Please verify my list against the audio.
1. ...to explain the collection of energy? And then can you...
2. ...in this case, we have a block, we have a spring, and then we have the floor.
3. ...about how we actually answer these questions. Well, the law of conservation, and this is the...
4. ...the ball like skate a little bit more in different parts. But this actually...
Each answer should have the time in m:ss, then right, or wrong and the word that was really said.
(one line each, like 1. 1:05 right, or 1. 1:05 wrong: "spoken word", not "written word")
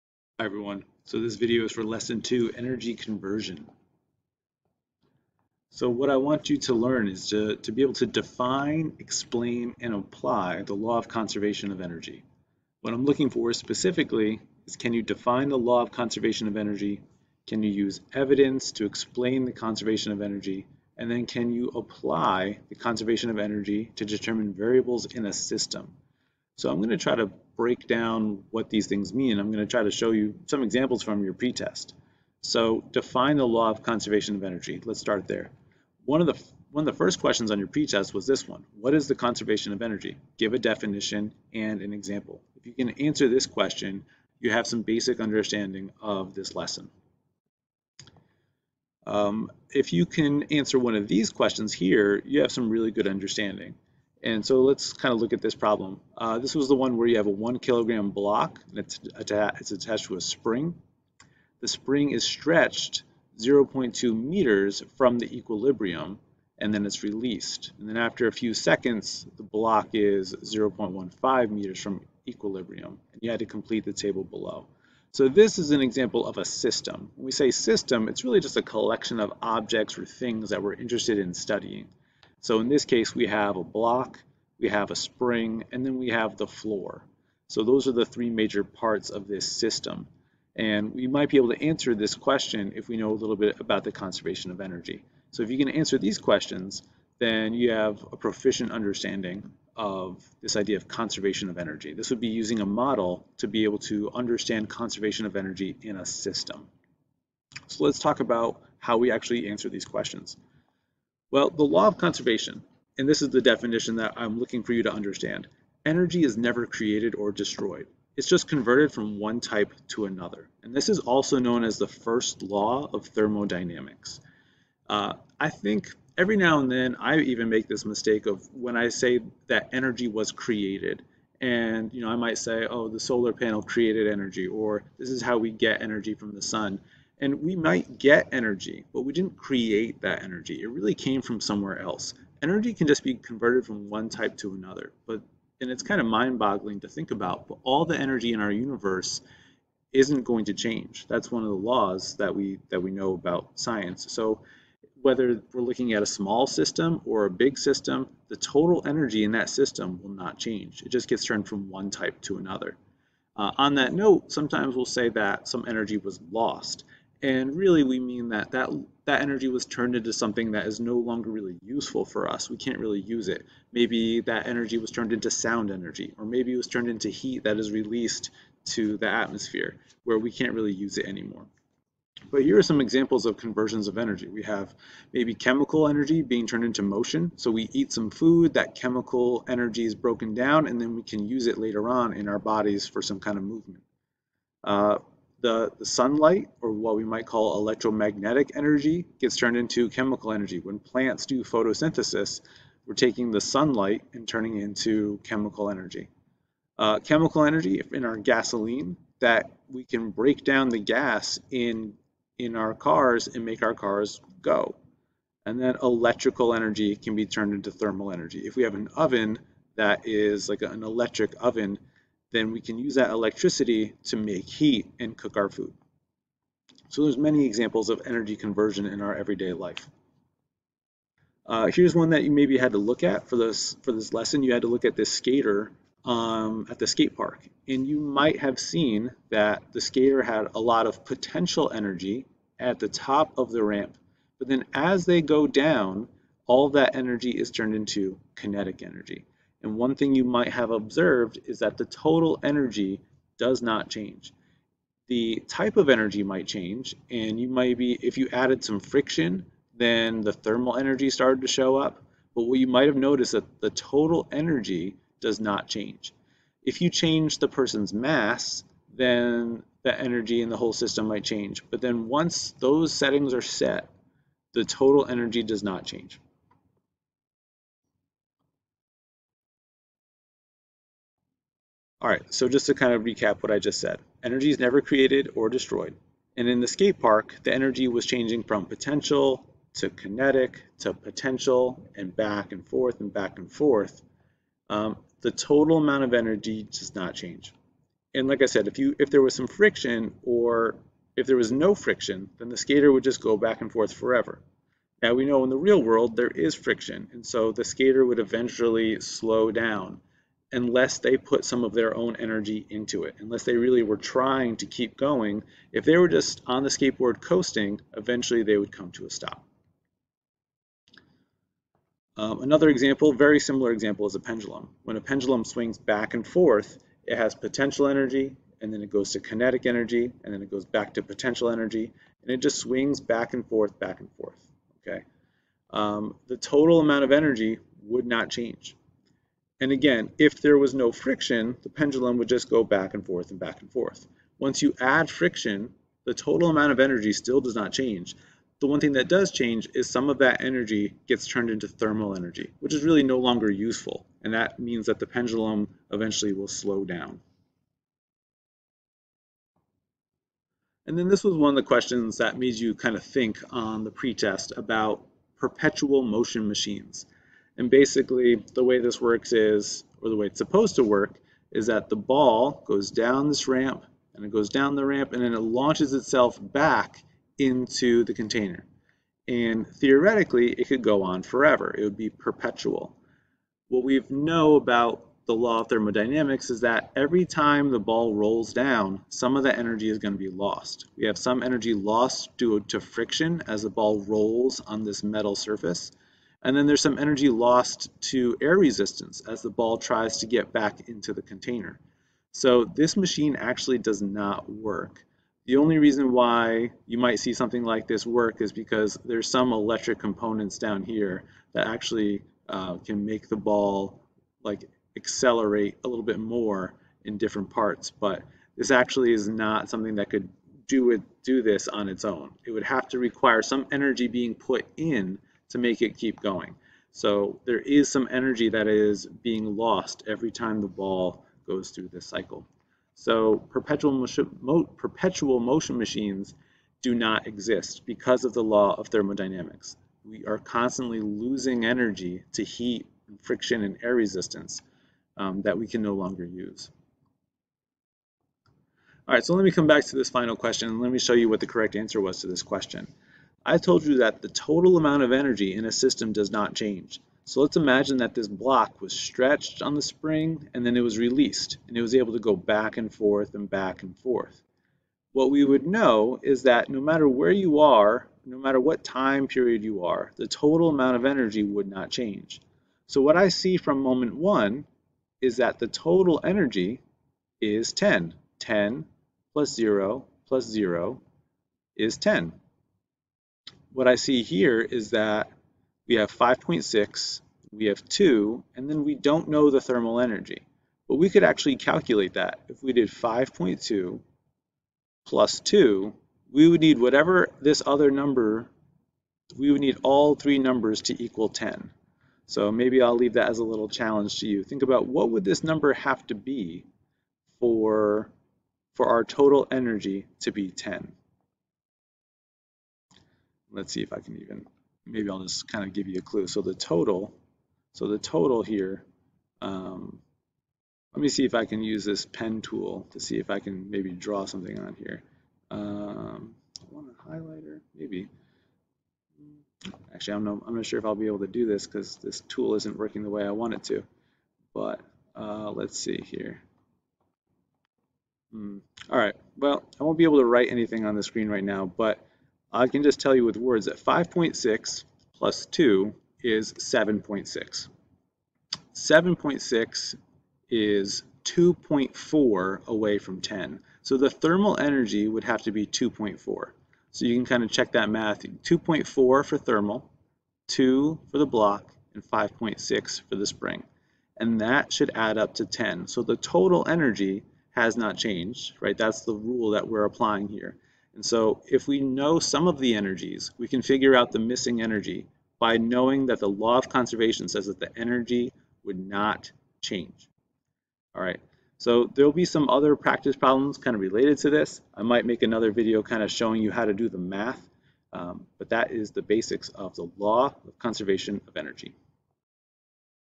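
1. 0:18 wrong: "conservation", not "collection"
2. 1:22 right
3. 1:48 right
4. 6:53 wrong: "accelerate", not "skate".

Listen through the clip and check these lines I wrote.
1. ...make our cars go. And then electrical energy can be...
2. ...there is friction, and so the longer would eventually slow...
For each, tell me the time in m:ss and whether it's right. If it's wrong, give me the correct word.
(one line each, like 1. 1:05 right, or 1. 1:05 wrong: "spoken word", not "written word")
1. 3:33 right
2. 5:06 wrong: "skater", not "longer".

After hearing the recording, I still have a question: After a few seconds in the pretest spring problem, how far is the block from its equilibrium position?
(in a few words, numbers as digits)
0.15 meters.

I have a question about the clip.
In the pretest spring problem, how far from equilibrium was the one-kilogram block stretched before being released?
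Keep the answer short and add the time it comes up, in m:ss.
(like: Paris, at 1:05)
0.2 meters, at 1:03.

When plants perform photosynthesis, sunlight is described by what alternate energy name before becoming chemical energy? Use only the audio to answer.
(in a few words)
electromagnetic energy.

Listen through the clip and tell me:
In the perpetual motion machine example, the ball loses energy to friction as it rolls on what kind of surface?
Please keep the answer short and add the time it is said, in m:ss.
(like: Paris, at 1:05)
metal surface, at 6:35.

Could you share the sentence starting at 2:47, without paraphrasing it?
And really, we mean that that that energy was turned into something that is no longer really useful for us.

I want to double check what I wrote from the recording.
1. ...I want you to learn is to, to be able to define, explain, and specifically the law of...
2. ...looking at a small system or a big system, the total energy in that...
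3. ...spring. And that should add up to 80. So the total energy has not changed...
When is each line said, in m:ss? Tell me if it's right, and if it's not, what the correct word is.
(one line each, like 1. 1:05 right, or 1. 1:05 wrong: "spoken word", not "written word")
1. 0:06 wrong: "apply", not "specifically"
2. 2:35 right
3. 9:23 wrong: "10", not "80".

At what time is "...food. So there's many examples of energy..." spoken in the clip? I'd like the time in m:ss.
3:45.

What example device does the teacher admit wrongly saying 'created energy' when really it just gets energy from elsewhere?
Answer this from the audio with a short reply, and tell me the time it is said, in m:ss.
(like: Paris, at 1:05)
solar panel, at 2:12.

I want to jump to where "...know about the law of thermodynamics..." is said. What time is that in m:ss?
6:24.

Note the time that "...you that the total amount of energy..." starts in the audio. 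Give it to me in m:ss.
7:33.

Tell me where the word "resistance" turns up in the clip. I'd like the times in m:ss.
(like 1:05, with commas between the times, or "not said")
6:38, 7:23.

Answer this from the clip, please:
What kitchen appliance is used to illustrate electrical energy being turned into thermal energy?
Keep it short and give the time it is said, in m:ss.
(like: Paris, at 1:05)
electric oven, at 3:40.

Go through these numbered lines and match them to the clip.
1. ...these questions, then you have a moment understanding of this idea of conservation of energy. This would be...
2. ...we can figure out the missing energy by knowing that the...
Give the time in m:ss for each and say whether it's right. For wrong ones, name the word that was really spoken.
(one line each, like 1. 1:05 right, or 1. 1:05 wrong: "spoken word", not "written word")
1. 1:35 wrong: "proficient", not "moment"
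2. 9:33 right.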